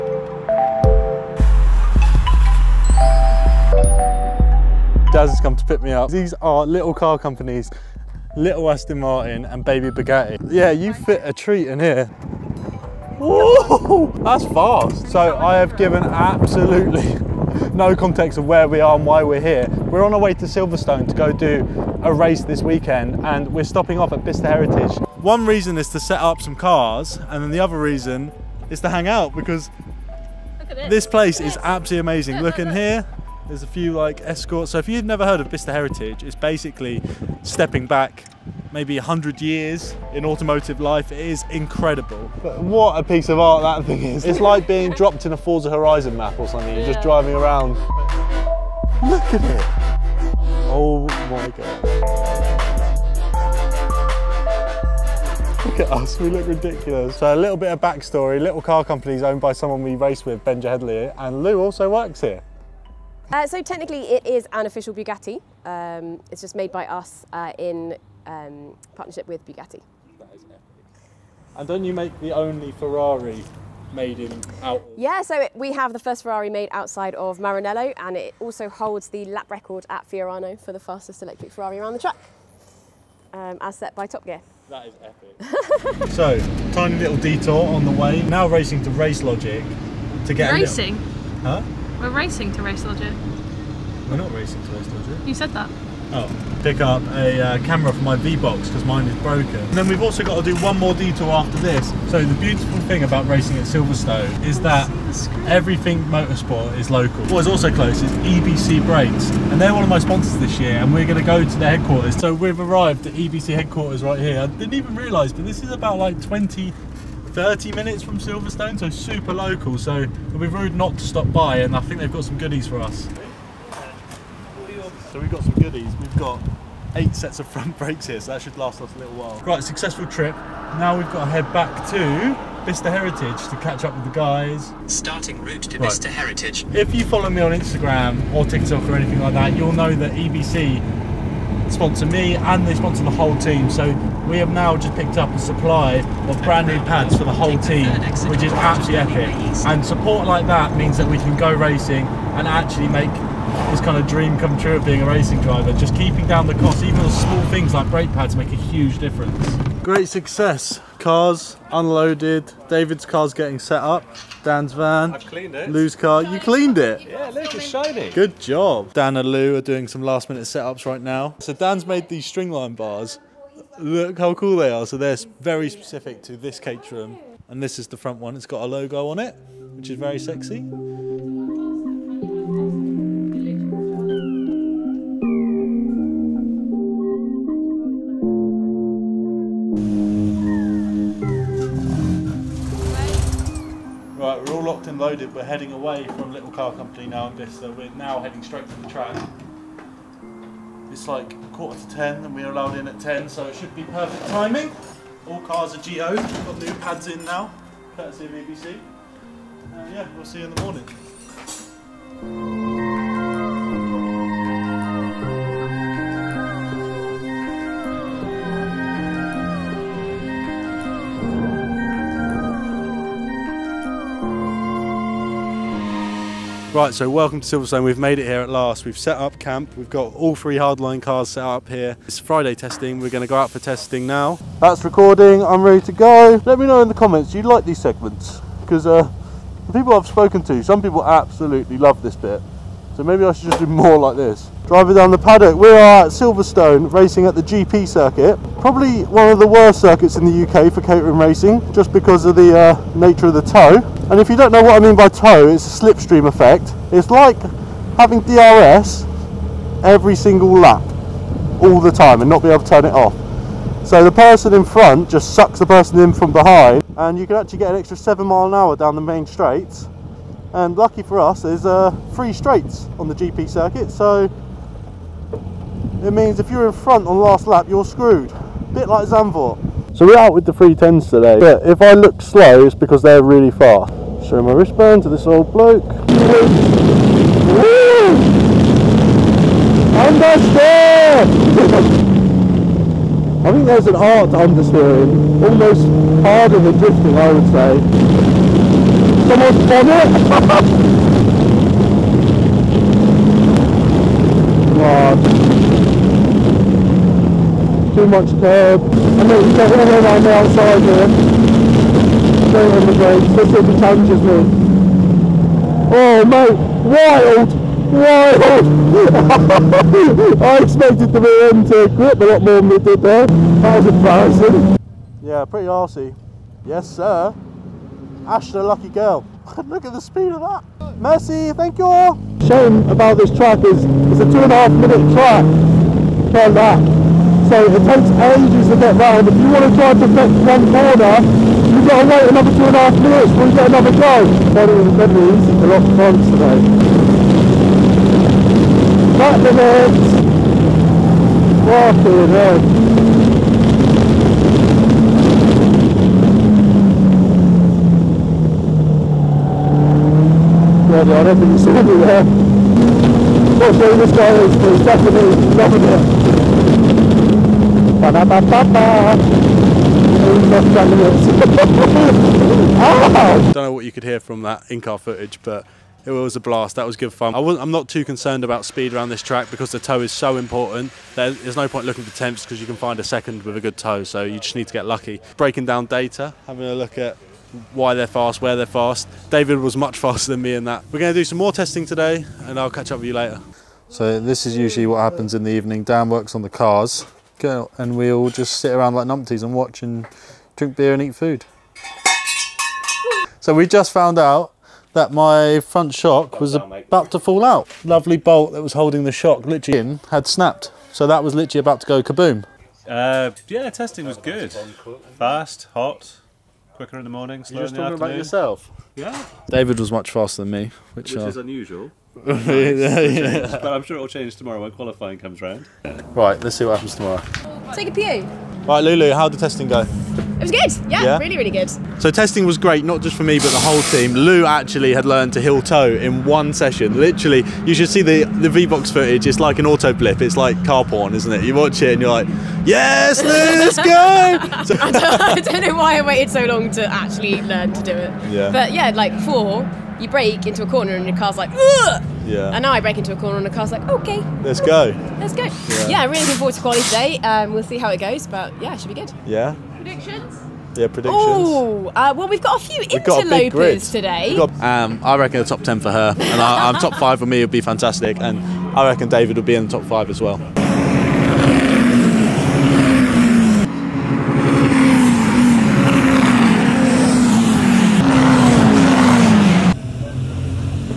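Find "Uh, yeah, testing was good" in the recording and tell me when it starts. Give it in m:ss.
6:52.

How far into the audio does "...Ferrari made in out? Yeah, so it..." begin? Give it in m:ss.
1:12.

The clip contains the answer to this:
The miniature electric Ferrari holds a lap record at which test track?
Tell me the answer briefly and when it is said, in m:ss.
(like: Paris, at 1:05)
Fiorano, at 1:20.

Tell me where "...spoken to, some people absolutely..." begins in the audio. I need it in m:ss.
4:00.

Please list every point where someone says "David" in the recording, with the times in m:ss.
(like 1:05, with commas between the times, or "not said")
2:42, 6:29, 6:59, 7:49.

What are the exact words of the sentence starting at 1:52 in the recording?
So we've arrived at EBC headquarters right here.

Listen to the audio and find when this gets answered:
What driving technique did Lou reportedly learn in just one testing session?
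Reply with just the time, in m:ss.
7:15.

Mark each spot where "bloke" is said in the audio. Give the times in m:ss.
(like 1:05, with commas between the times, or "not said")
4:45.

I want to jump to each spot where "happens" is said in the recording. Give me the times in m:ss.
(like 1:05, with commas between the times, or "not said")
6:34, 7:06.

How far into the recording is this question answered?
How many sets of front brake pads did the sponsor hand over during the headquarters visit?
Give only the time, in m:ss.
2:06.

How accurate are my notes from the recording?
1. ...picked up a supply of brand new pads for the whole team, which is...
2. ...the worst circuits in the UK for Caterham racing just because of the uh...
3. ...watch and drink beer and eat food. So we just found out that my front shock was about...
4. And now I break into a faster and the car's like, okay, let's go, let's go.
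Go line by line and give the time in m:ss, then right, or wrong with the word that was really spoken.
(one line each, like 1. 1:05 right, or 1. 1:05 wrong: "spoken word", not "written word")
1. 2:24 right
2. 4:09 right
3. 6:39 right
4. 7:32 wrong: "corner", not "faster".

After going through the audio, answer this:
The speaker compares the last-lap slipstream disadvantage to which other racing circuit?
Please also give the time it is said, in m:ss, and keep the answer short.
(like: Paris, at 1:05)
Zandvoort, at 4:39.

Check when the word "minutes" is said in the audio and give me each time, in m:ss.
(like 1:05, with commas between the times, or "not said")
1:57, 2:50, 5:34, 5:42.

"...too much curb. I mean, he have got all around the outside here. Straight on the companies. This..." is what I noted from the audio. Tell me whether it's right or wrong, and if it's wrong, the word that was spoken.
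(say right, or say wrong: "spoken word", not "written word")
wrong: "brakes", not "companies".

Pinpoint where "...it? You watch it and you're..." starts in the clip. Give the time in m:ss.
7:21.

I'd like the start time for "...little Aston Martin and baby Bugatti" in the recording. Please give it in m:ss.
0:08.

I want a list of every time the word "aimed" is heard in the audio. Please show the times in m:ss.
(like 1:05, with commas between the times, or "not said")
not said.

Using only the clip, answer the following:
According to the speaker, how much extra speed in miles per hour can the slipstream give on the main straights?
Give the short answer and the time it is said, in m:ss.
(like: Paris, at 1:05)
7, at 4:27.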